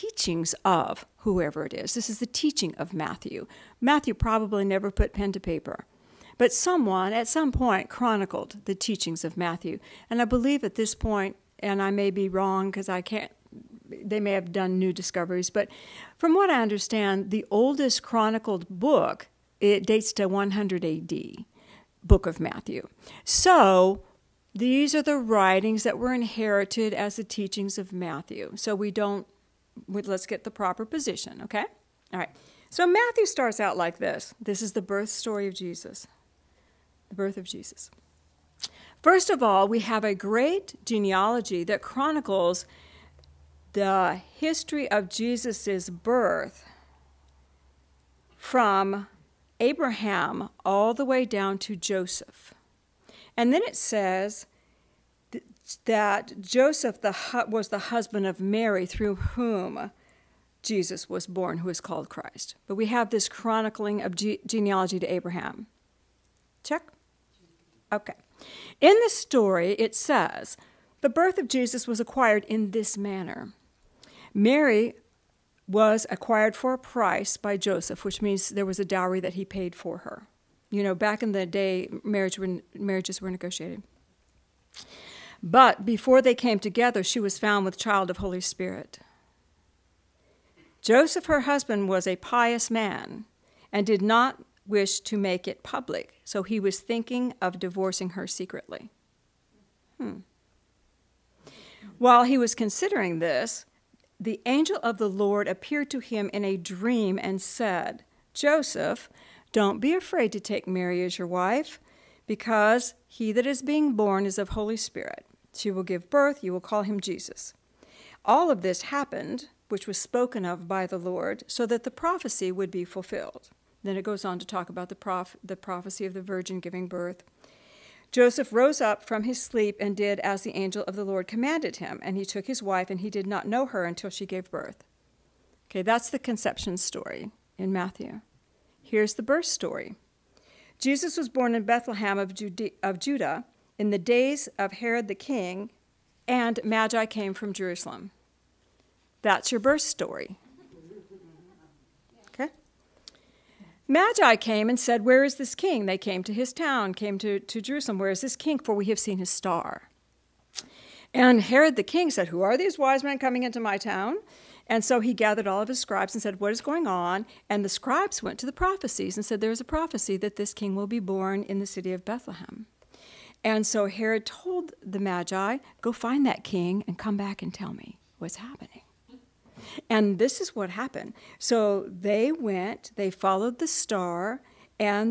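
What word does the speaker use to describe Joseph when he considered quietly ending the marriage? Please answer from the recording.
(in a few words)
pious.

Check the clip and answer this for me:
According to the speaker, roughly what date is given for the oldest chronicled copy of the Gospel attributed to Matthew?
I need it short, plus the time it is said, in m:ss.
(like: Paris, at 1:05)
100 AD, at 0:20.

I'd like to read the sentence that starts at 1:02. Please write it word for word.
But we have this chronicling of ge genealogy to Abraham.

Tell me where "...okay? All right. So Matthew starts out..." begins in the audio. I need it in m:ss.
0:31.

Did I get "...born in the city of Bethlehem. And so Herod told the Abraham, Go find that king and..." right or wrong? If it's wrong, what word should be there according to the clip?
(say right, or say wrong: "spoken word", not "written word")
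wrong: "Magi", not "Abraham".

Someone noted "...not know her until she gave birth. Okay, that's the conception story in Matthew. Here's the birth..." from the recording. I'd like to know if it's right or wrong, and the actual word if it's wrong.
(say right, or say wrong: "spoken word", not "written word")
right.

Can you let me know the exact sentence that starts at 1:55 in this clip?
She will give birth, you will call him Jesus.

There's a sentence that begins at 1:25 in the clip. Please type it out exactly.
But before they came together, she was found with child of Holy Spirit.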